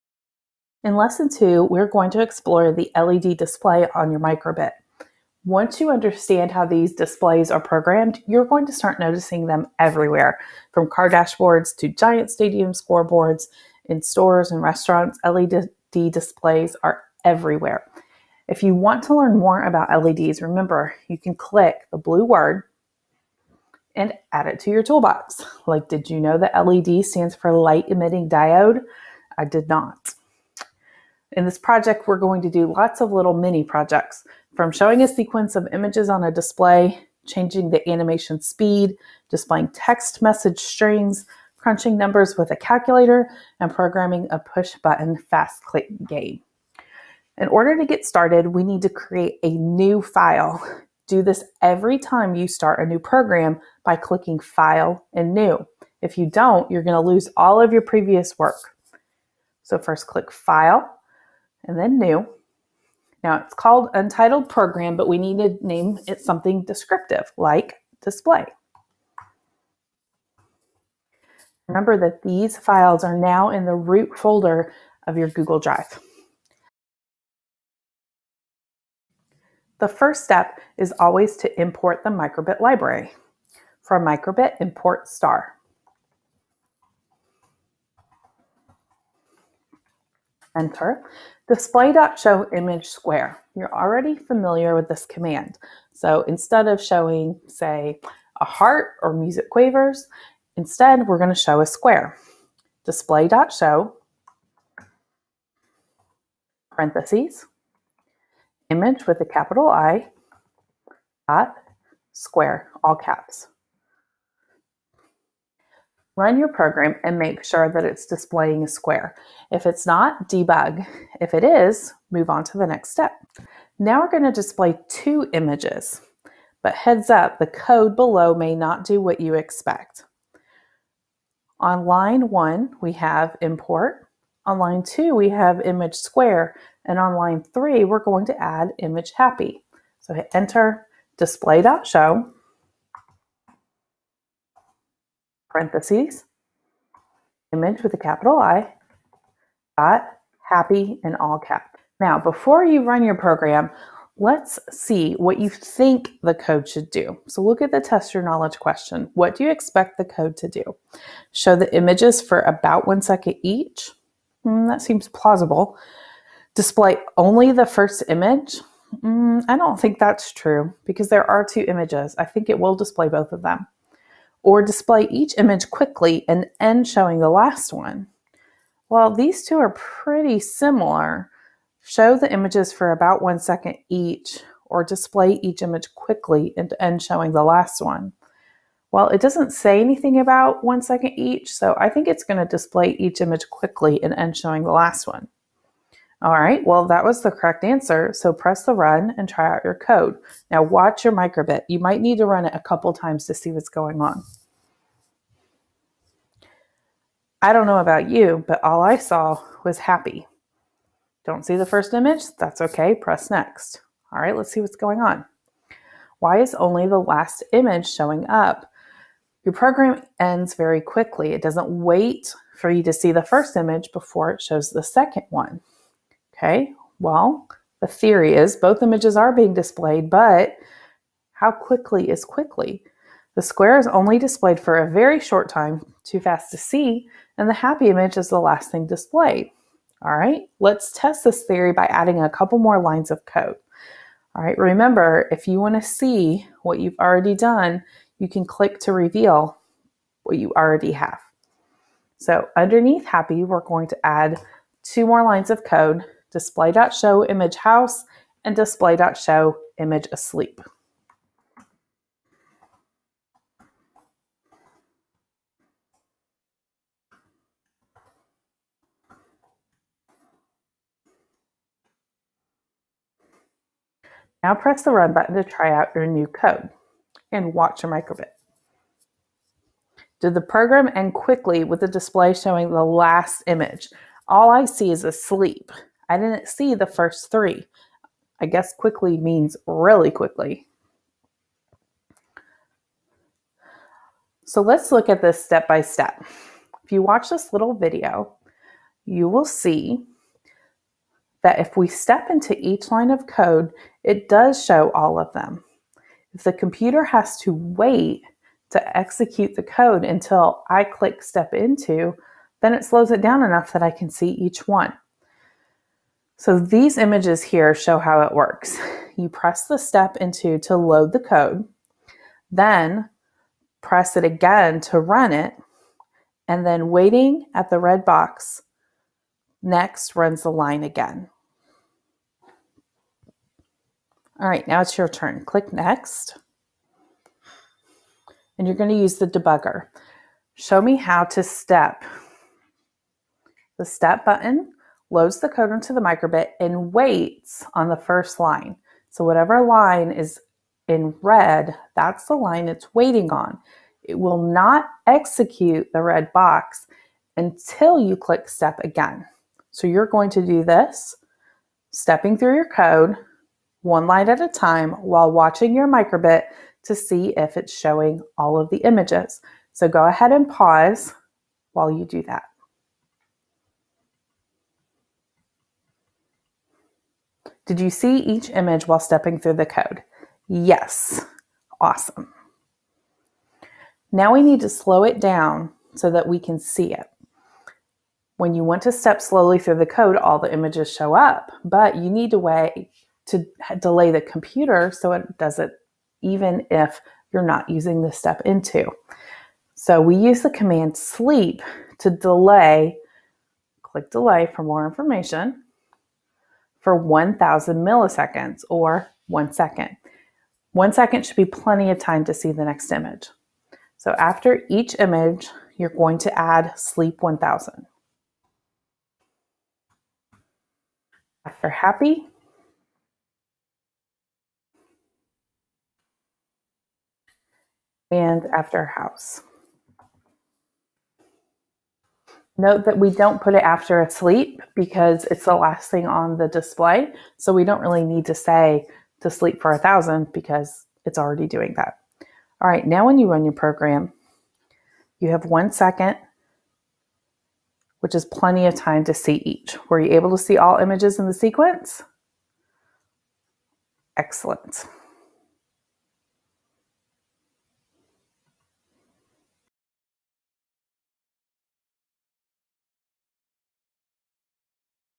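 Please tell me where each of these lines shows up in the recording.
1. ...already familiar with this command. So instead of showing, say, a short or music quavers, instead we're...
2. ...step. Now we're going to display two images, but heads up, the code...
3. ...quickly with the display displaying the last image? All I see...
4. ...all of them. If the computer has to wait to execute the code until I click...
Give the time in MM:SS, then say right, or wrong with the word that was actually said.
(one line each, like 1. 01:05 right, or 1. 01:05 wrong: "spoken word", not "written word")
1. 01:33 wrong: "heart", not "short"
2. 02:02 right
3. 04:41 wrong: "showing", not "displaying"
4. 05:04 right.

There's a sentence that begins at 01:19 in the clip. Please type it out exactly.
The first step is always to import the microbit library.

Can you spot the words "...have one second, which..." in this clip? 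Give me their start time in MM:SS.
07:25.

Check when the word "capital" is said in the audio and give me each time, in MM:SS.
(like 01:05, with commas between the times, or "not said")
01:49, 02:27.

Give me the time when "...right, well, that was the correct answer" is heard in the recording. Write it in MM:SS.
03:16.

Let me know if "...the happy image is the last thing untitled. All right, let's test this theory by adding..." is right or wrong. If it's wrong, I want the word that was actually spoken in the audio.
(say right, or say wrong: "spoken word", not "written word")
wrong: "displayed", not "untitled".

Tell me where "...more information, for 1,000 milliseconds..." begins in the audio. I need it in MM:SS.
06:44.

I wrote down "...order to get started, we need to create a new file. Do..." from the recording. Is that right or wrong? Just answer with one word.
right.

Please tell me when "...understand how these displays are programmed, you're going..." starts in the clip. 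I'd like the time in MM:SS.
00:05.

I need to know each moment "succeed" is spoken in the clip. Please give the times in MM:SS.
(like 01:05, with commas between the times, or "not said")
not said.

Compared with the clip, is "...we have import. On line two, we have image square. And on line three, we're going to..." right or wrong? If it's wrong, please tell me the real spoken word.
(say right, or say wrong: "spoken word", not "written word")
right.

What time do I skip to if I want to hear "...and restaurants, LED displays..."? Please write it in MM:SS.
00:14.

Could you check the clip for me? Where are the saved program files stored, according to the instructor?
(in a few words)
Google Drive.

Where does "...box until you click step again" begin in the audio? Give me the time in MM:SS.
05:56.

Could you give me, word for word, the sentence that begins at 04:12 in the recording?
So underneath happy, we're going to add two more lines of code display.show image house and display.show image asleep.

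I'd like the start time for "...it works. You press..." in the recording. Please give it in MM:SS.
05:18.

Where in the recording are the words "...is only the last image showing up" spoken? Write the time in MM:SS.
03:36.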